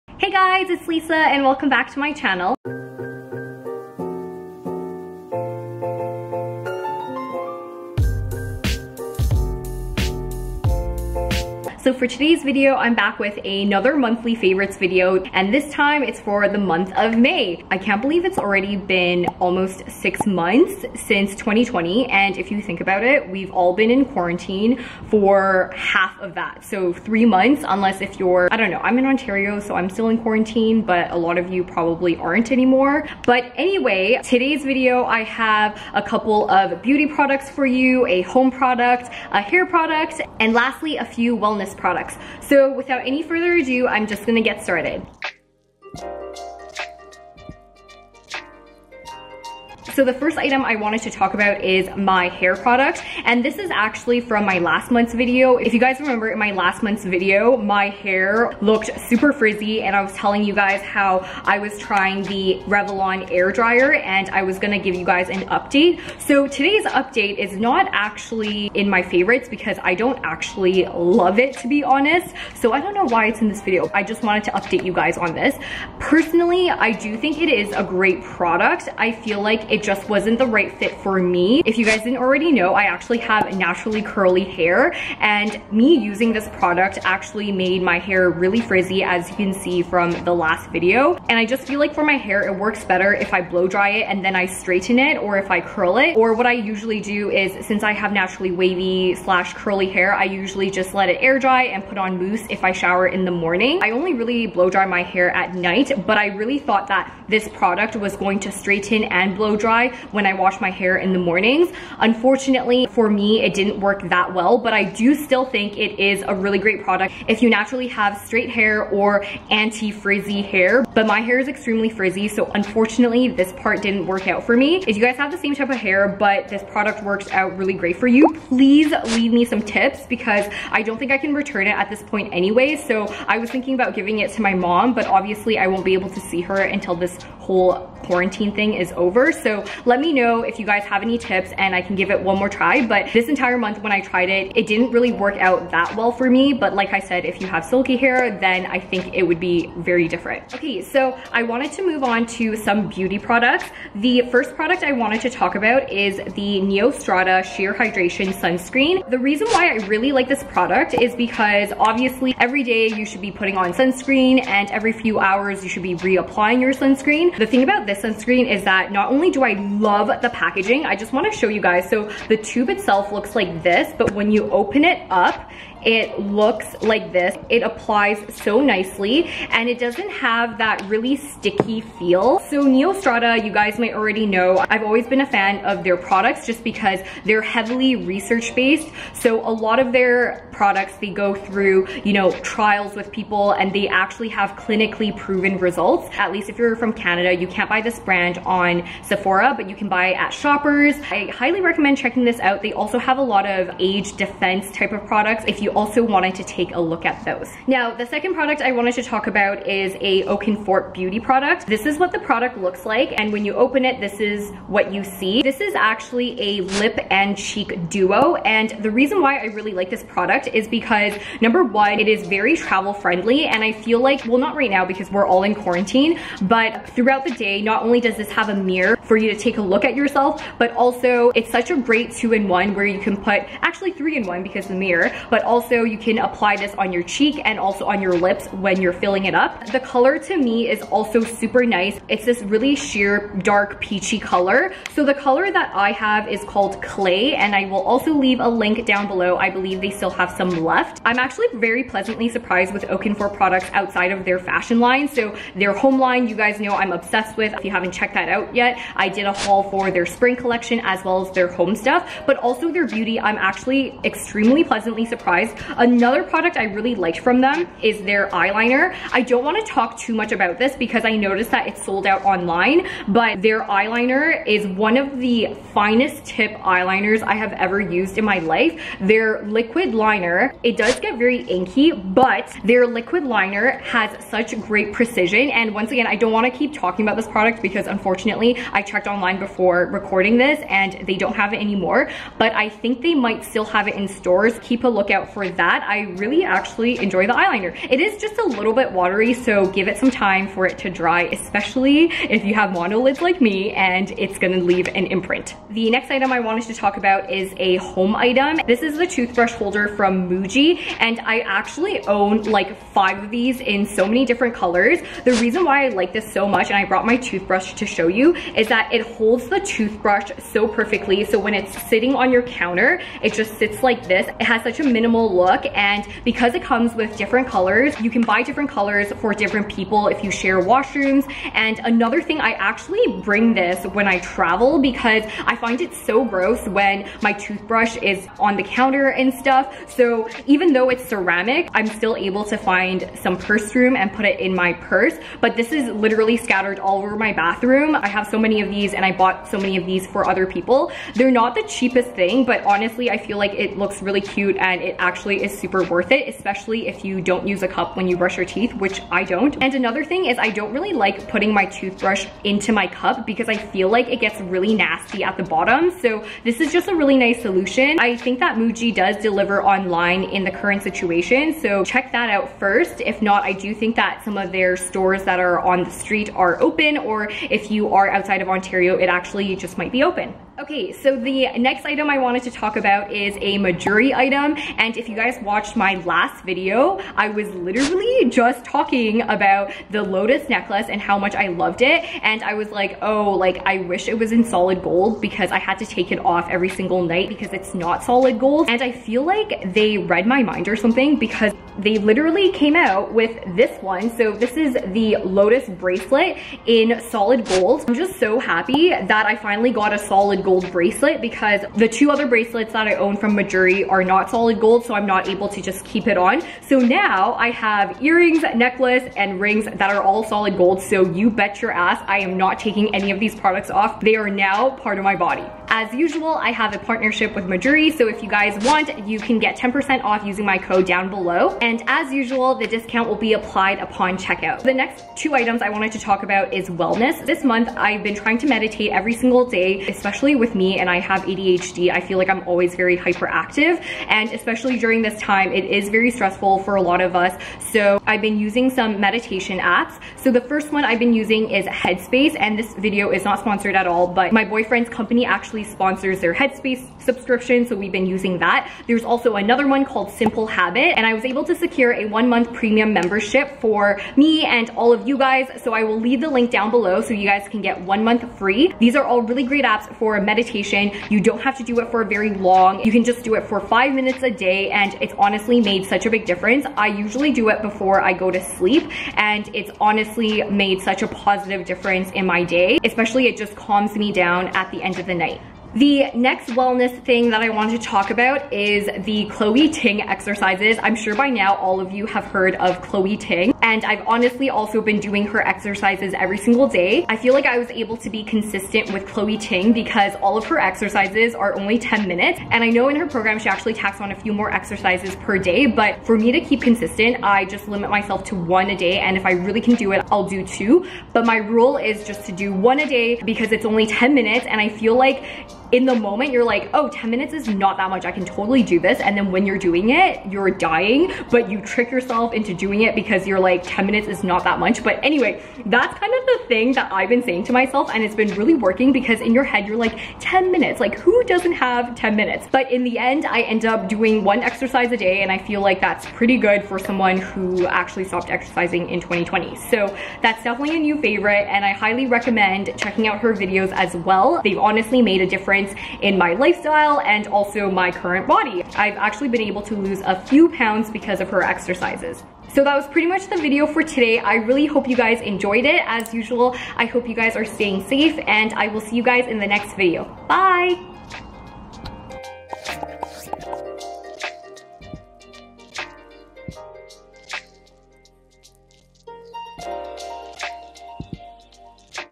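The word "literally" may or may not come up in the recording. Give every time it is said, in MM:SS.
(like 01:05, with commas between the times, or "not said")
05:45, 06:27, 06:41.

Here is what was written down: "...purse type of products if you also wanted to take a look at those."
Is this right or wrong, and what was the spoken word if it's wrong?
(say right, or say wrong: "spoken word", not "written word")
wrong: "defense", not "purse".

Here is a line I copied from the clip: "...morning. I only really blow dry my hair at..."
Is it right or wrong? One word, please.
right.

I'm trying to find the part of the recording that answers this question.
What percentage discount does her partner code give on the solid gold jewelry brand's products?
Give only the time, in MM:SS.
07:09.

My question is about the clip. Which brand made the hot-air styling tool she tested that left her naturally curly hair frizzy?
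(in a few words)
Revlon.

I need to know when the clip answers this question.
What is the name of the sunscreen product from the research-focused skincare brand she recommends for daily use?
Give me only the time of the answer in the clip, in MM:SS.
02:36.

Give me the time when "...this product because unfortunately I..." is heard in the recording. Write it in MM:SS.
04:47.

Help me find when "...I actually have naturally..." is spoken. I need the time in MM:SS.
01:22.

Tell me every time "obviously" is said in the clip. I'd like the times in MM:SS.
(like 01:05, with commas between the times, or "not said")
02:15, 02:41.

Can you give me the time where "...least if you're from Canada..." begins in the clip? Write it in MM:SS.
03:16.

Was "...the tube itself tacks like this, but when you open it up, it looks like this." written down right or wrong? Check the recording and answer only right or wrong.
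wrong.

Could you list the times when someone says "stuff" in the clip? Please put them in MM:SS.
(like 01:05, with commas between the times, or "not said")
04:21, 05:39.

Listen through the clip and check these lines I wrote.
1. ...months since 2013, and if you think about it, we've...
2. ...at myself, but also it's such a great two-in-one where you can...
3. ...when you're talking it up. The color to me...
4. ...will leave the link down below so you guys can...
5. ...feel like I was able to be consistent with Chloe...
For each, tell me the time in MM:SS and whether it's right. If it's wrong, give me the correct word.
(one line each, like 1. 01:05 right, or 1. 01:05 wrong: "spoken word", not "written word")
1. 00:20 wrong: "2020", not "2013"
2. 03:49 wrong: "yourself", not "myself"
3. 03:58 wrong: "filling", not "talking"
4. 07:45 right
5. 08:17 right.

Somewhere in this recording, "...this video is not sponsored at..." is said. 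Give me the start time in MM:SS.
07:32.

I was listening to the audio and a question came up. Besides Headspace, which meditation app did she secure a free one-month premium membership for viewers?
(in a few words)
Simple Habit.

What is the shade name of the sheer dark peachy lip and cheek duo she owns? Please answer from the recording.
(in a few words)
Clay.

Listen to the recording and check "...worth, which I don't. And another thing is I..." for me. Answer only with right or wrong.
wrong.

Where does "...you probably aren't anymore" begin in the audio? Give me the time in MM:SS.
00:31.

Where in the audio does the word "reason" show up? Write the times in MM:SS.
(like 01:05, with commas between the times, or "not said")
02:39, 03:38, 05:15.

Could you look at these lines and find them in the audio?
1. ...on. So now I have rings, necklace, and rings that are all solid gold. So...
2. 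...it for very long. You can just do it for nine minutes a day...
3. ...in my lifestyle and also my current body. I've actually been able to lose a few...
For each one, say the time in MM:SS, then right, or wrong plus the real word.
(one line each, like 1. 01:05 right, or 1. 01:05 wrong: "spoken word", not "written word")
1. 06:56 wrong: "earrings", not "rings"
2. 07:51 wrong: "five", not "nine"
3. 09:06 right.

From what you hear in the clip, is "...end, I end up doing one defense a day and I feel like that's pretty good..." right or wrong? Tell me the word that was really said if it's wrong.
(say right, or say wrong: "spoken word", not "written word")
wrong: "exercise", not "defense".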